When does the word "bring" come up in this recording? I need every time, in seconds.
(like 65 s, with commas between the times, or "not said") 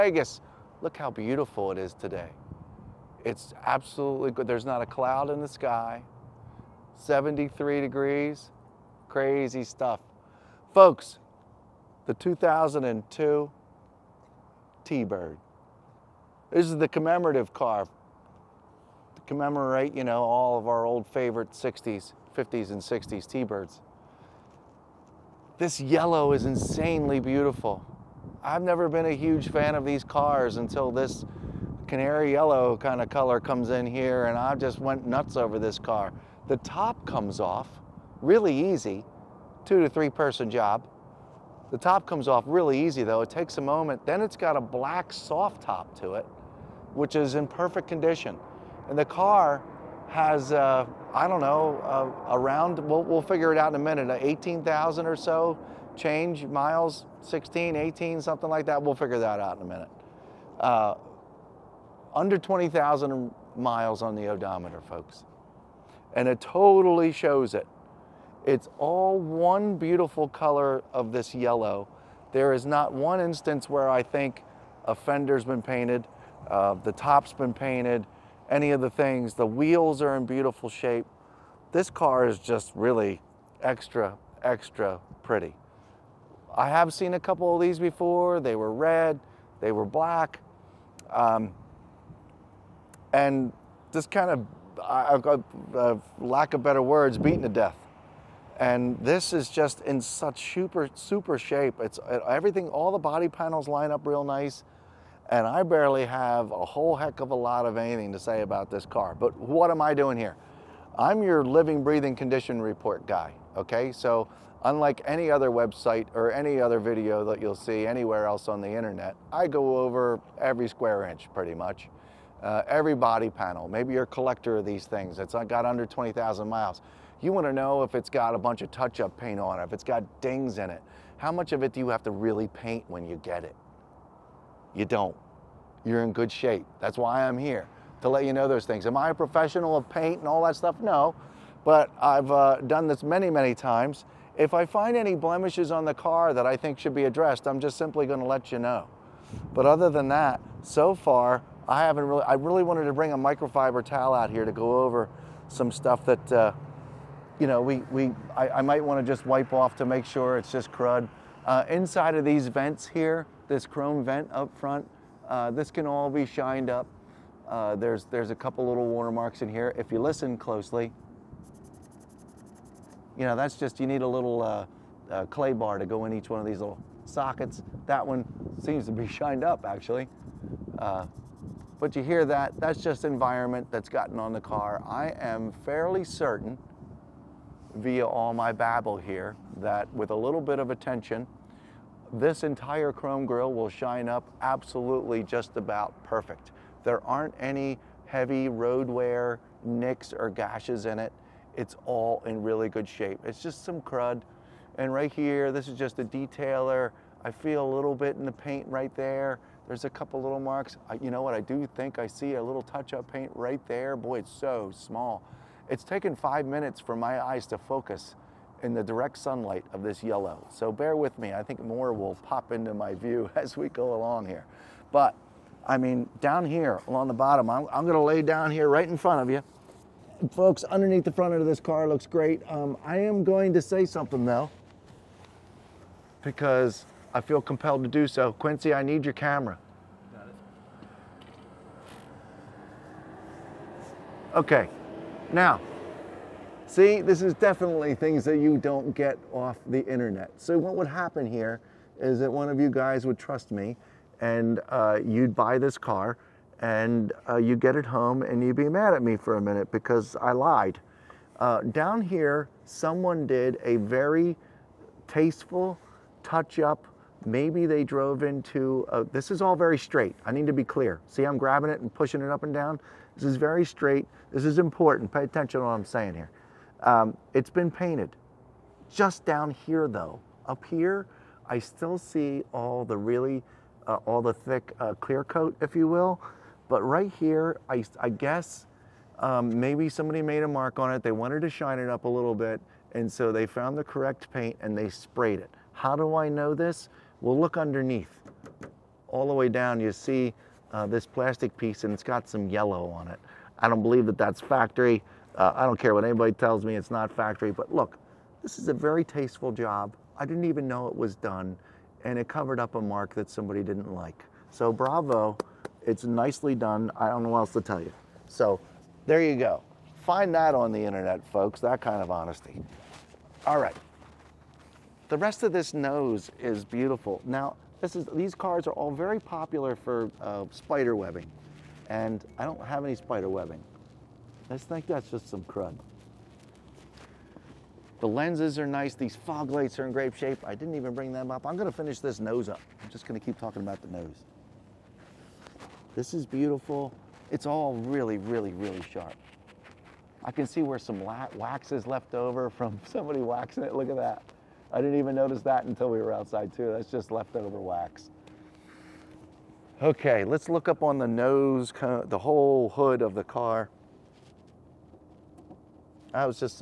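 152 s, 340 s.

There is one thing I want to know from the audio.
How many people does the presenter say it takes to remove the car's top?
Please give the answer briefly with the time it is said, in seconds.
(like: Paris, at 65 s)
2 to 3, at 39 s.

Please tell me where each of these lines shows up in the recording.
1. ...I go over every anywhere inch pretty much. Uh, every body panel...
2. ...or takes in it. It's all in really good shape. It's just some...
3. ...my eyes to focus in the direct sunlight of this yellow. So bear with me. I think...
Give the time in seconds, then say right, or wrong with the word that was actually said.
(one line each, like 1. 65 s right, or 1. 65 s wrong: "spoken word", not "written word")
1. 119 s wrong: "square", not "anywhere"
2. 200 s wrong: "gashes", not "takes"
3. 216 s right.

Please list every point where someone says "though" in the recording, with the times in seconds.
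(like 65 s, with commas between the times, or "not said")
43 s, 234 s, 279 s.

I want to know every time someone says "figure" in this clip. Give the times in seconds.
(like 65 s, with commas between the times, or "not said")
53 s, 58 s.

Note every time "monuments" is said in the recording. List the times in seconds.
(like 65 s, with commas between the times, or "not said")
not said.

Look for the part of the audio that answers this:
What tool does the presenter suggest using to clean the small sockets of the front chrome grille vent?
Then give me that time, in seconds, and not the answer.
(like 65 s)
175 s.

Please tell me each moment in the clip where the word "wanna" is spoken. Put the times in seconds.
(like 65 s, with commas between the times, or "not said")
127 s, 158 s.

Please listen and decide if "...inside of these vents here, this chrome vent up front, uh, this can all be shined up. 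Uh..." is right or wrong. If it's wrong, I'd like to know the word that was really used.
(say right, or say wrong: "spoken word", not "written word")
right.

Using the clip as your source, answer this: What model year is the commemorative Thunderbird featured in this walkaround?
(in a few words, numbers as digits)
2002.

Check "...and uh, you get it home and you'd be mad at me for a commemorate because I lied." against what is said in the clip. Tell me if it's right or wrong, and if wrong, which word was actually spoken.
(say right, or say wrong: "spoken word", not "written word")
wrong: "minute", not "commemorate".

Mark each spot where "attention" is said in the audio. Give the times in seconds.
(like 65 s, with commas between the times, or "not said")
190 s, 275 s.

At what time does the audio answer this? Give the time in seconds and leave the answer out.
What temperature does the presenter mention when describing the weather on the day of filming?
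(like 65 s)
6 s.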